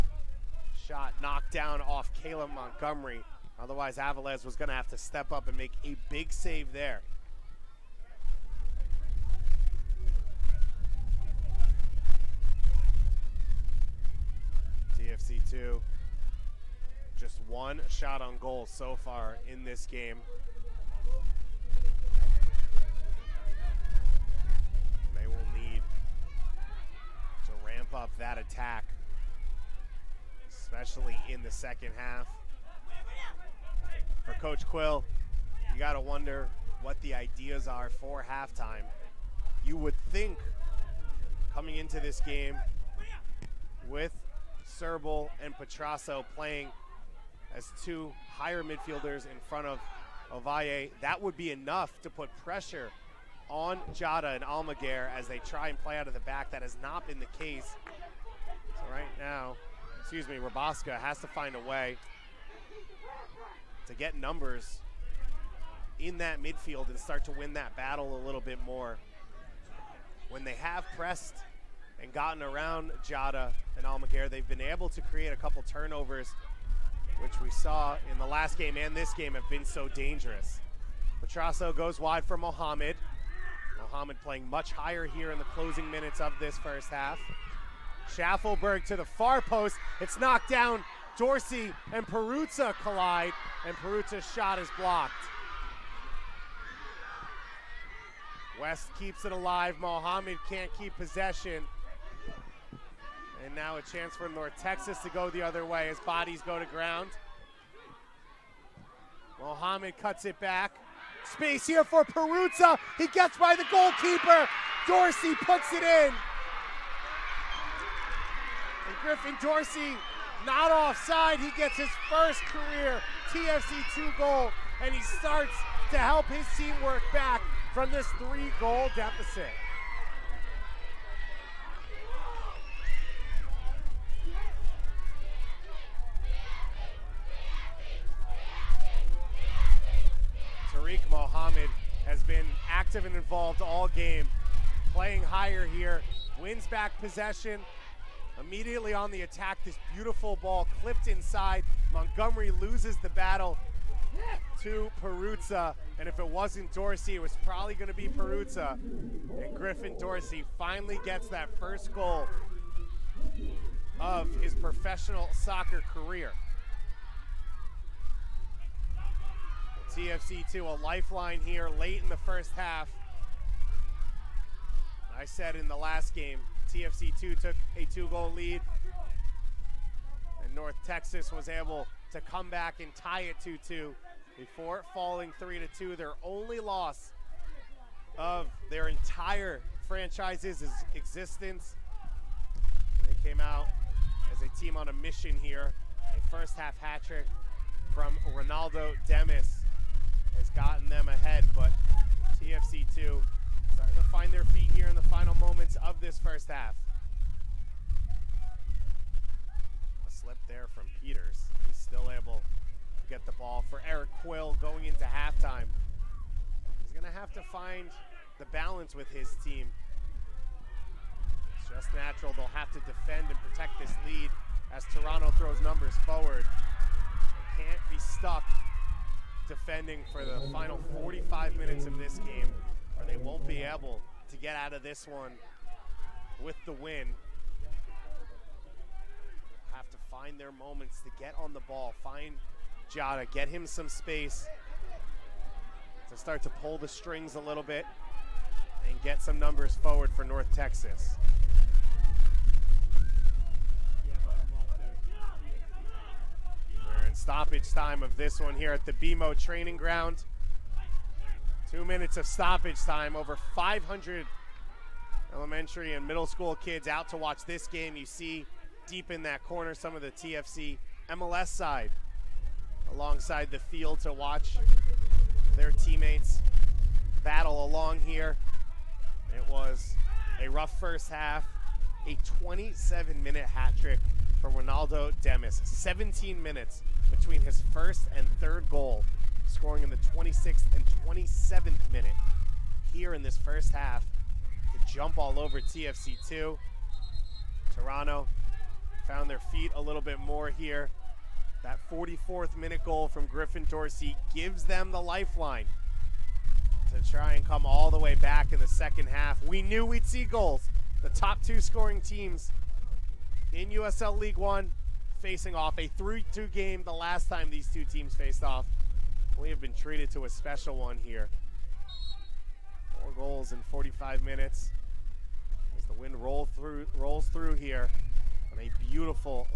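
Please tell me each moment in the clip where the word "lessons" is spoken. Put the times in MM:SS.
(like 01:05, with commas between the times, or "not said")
not said.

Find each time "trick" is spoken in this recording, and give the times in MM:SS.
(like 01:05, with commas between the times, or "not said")
03:17, 04:43.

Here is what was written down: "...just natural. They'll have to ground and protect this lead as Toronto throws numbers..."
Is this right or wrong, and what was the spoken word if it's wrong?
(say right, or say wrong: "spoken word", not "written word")
wrong: "defend", not "ground".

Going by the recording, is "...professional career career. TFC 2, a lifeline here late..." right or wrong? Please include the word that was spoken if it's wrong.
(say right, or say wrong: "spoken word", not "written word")
wrong: "soccer", not "career".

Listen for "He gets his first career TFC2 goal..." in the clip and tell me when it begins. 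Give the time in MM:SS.
02:01.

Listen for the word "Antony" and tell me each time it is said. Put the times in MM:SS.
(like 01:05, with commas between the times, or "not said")
not said.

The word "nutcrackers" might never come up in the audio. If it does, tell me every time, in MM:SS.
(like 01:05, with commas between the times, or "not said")
not said.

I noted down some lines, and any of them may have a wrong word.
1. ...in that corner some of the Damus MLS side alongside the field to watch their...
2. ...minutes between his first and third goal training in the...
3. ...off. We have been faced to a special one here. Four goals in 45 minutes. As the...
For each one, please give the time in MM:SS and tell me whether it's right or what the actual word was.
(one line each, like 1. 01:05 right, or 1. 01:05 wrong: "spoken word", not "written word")
1. 04:29 wrong: "TFC", not "Damus"
2. 04:46 wrong: "scoring", not "training"
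3. 05:18 wrong: "treated", not "faced".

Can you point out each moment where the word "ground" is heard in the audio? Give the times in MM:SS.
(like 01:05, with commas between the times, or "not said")
01:46, 04:19.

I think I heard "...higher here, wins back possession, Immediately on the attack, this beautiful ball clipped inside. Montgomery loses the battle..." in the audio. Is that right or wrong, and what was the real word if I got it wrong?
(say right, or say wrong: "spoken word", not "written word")
right.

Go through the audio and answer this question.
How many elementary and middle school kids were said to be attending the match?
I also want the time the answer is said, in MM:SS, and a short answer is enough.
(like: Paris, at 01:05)
500, at 04:23.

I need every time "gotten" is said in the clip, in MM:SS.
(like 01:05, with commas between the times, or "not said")
01:12, 03:20.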